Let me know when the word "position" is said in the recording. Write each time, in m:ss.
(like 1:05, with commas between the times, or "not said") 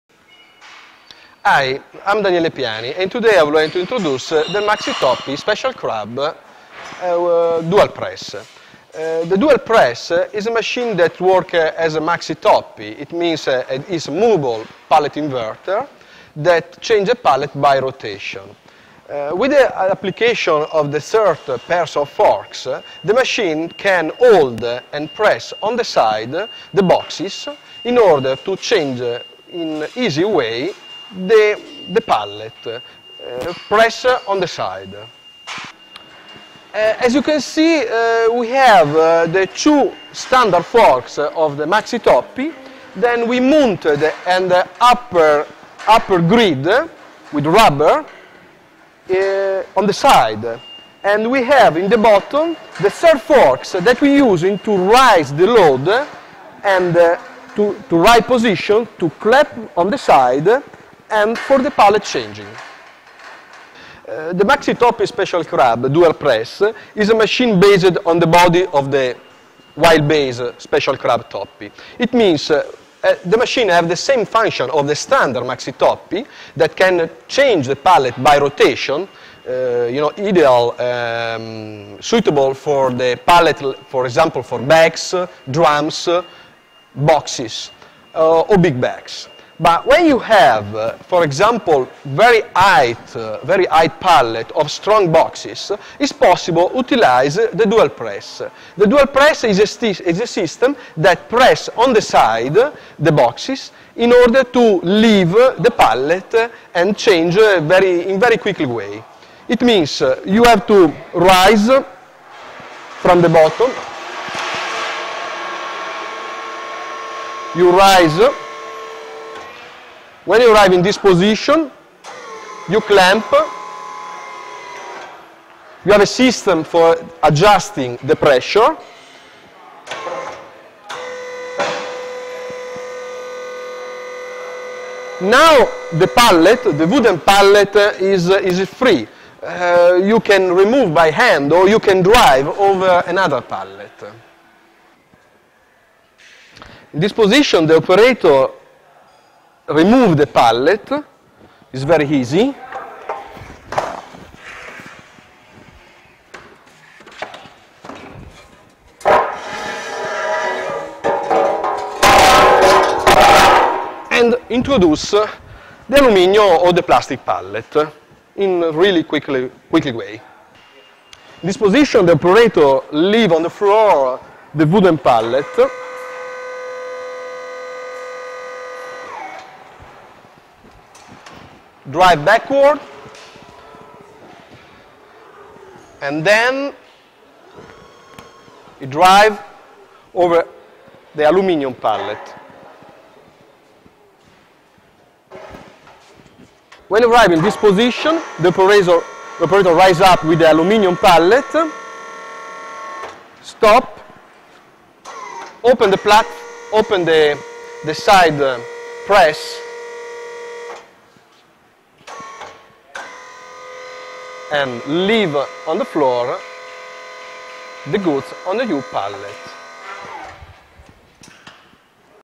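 0:58, 2:00, 2:27, 2:51, 3:17.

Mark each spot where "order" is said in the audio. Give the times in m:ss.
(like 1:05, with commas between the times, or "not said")
0:27, 1:44.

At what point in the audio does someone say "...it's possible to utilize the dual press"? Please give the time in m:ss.
1:35.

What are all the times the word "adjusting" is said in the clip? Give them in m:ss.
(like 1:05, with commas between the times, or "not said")
2:07.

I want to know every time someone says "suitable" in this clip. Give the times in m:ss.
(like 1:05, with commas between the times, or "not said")
1:22.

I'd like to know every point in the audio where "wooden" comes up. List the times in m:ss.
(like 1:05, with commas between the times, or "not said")
2:16, 2:54.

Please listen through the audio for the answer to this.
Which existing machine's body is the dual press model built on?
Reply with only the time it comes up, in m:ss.
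1:09.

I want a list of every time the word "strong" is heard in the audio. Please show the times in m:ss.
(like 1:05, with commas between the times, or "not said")
1:34.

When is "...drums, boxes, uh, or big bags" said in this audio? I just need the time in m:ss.
1:25.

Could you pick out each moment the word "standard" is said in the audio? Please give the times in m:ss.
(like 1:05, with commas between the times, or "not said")
0:40, 1:14.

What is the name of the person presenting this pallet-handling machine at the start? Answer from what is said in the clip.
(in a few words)
Daniele Piani.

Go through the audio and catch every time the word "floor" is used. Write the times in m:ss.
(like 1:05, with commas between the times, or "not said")
2:53, 3:35.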